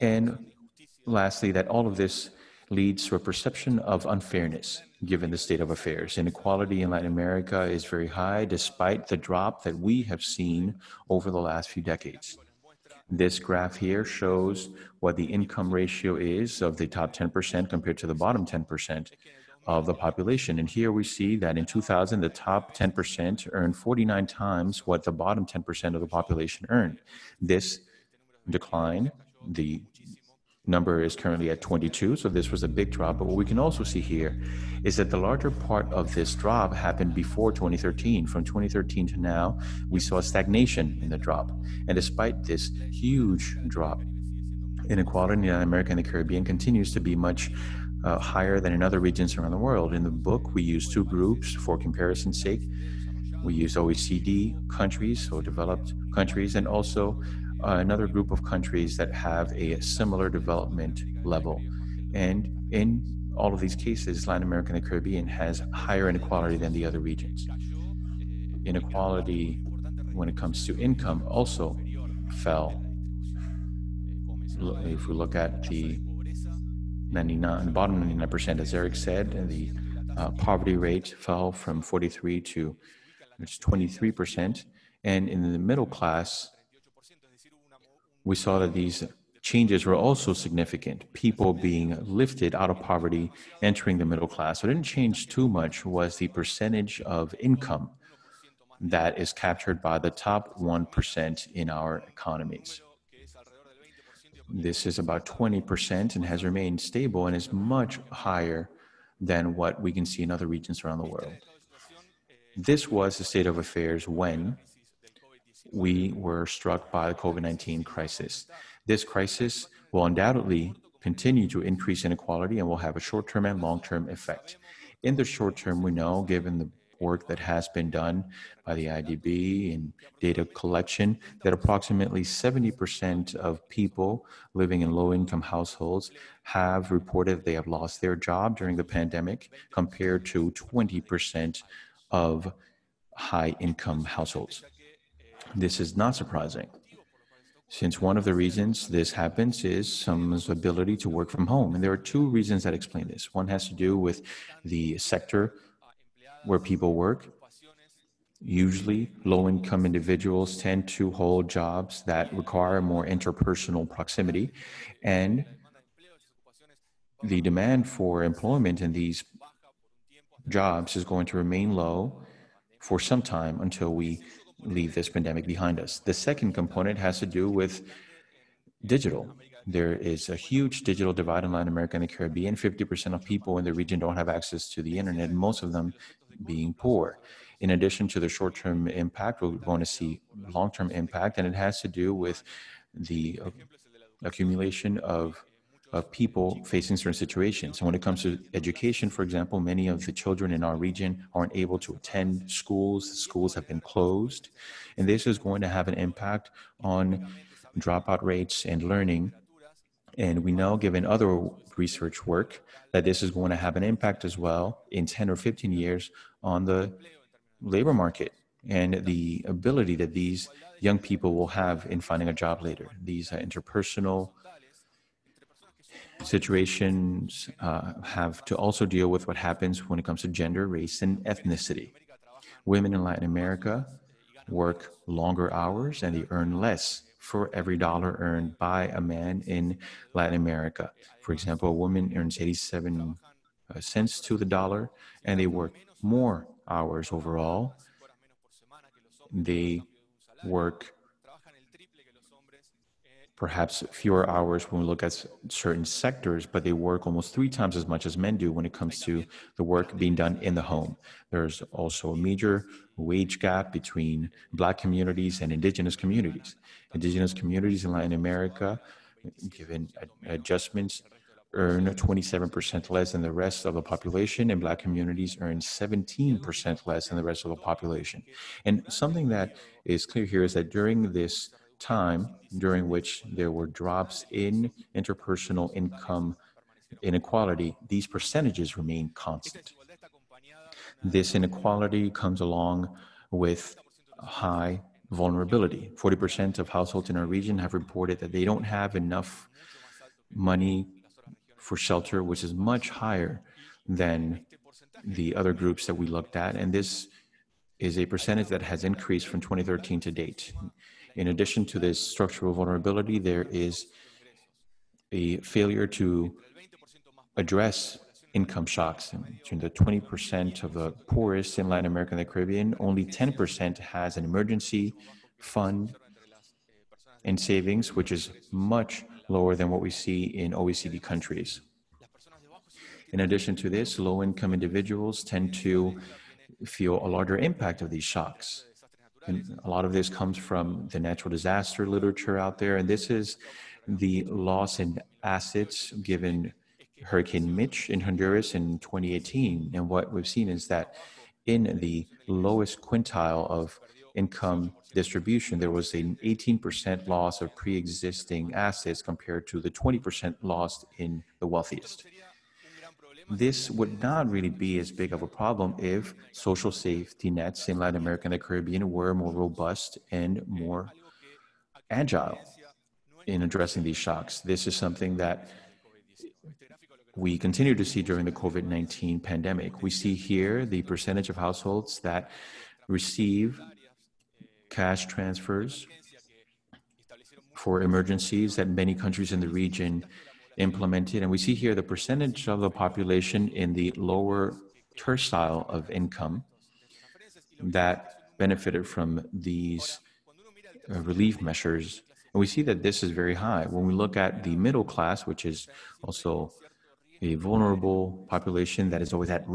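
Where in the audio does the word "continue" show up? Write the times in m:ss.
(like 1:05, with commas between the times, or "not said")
0:46, 2:01, 6:17.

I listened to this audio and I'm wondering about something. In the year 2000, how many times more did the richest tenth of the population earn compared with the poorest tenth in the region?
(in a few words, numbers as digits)
49.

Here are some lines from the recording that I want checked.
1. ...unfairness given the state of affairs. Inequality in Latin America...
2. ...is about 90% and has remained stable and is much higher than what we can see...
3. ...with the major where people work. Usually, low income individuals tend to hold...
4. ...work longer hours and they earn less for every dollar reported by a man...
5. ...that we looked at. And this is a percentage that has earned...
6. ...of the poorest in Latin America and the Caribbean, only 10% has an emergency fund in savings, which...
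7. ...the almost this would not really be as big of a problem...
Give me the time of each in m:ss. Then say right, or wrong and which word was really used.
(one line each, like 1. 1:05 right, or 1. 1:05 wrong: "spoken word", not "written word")
1. 0:04 right
2. 1:44 wrong: "20", not "90"
3. 2:33 wrong: "sector", not "major"
4. 3:54 wrong: "earned", not "reported"
5. 5:05 wrong: "increased", not "earned"
6. 5:20 right
7. 6:01 wrong: "wealthiest", not "almost".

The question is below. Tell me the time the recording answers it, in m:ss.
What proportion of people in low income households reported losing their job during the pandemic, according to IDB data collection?
2:11.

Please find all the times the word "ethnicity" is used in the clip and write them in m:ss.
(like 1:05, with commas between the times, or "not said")
3:51.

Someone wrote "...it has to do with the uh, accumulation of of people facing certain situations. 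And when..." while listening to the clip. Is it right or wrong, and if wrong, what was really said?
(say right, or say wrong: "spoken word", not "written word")
right.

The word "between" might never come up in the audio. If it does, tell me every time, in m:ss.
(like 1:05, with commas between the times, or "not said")
4:23, 5:19.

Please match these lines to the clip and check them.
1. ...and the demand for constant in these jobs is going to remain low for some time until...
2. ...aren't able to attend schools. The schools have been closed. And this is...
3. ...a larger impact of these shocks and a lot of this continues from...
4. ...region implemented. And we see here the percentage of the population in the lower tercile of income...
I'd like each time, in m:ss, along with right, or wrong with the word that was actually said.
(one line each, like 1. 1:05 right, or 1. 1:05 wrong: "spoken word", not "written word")
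1. 2:45 wrong: "employment", not "constant"
2. 3:21 right
3. 5:37 wrong: "comes", not "continues"
4. 6:29 right.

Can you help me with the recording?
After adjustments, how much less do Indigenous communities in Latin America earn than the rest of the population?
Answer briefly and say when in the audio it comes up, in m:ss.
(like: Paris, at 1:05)
27%, at 4:31.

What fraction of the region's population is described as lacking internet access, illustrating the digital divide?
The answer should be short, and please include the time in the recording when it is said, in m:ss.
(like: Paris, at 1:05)
50%, at 3:02.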